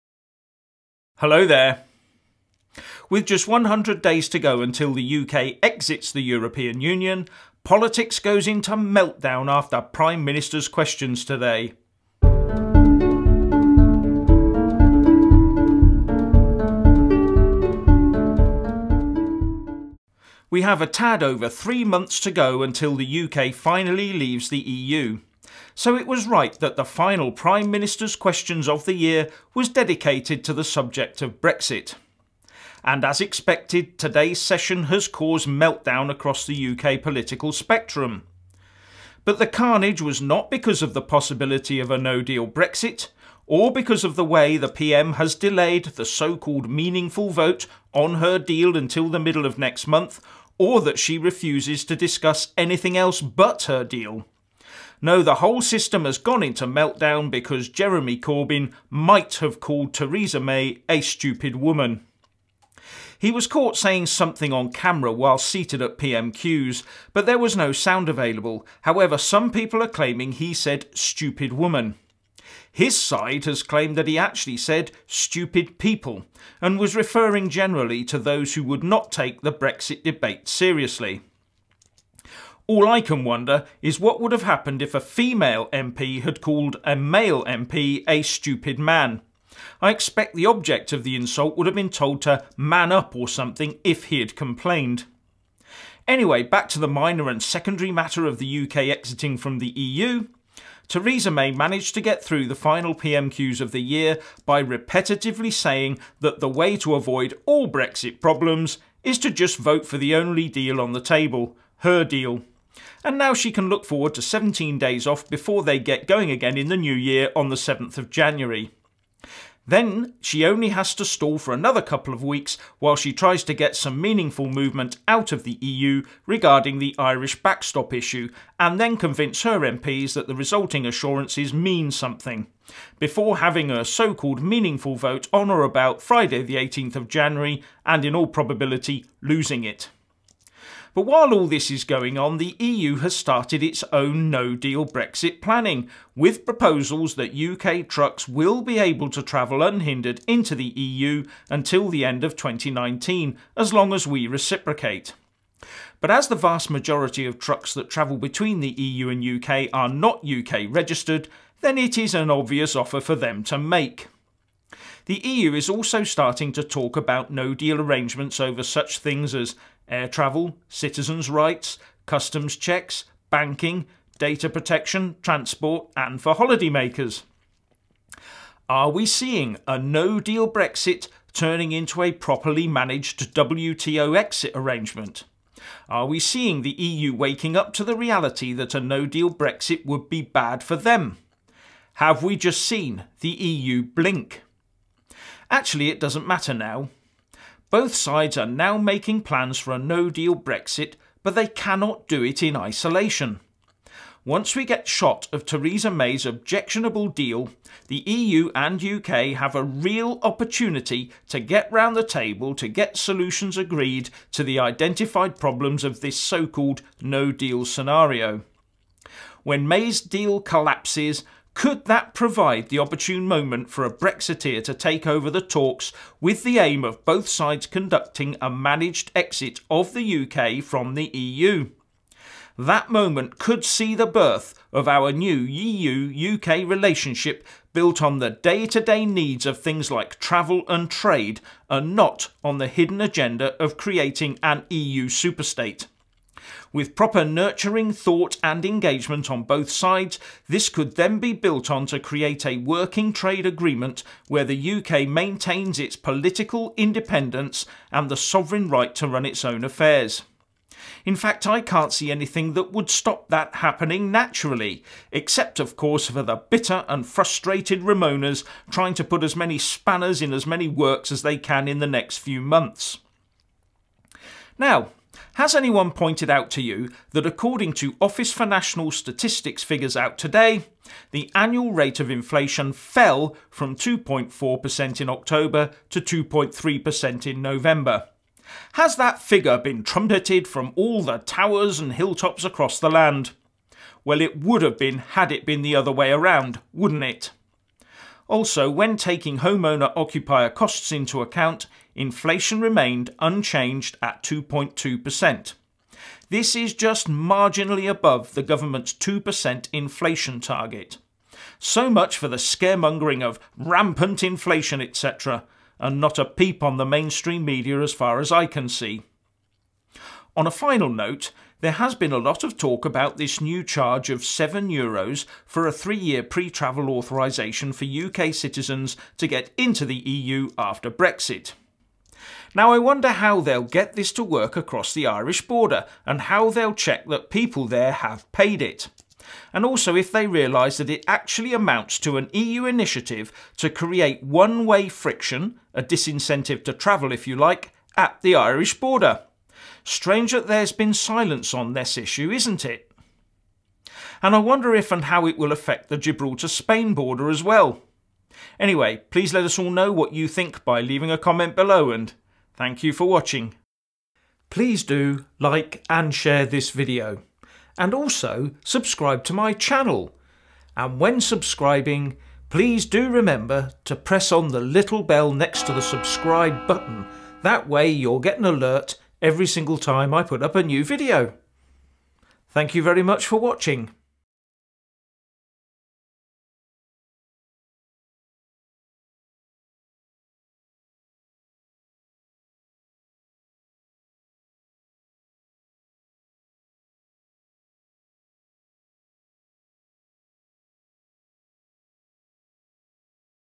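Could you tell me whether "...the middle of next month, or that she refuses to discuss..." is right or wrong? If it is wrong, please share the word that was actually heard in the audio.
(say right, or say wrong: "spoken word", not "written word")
right.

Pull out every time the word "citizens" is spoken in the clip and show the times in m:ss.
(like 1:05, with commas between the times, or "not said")
2:50, 5:28.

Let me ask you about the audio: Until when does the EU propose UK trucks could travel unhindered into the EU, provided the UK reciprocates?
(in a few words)
end of 2019.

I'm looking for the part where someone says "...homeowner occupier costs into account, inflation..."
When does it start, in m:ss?
4:59.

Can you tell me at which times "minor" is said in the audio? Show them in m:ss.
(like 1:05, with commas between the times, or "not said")
1:36.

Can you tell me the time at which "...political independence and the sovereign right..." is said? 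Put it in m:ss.
4:15.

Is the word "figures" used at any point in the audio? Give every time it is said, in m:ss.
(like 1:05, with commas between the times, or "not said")
4:39, 4:49.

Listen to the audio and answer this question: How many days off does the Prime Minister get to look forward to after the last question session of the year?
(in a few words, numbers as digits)
17.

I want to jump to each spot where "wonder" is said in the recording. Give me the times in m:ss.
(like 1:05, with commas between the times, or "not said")
1:23, 5:32, 5:54.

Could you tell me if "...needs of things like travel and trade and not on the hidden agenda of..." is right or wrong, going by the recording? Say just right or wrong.
right.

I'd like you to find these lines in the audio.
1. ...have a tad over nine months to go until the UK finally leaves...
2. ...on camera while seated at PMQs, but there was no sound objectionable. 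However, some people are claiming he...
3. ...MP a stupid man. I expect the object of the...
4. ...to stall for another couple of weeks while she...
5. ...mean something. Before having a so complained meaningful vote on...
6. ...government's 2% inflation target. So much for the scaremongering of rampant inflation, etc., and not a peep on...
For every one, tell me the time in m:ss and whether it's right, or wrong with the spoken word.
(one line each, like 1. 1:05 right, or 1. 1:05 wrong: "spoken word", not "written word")
1. 0:20 wrong: "three", not "nine"
2. 1:04 wrong: "available", not "objectionable"
3. 1:27 right
4. 2:00 right
5. 2:11 wrong: "called", not "complained"
6. 5:08 right.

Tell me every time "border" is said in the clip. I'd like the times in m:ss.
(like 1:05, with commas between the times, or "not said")
5:35, 5:48, 5:56.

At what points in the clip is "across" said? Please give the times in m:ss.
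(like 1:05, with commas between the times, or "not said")
0:36, 4:52, 5:34.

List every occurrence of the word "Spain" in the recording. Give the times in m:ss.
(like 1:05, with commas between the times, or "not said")
5:56.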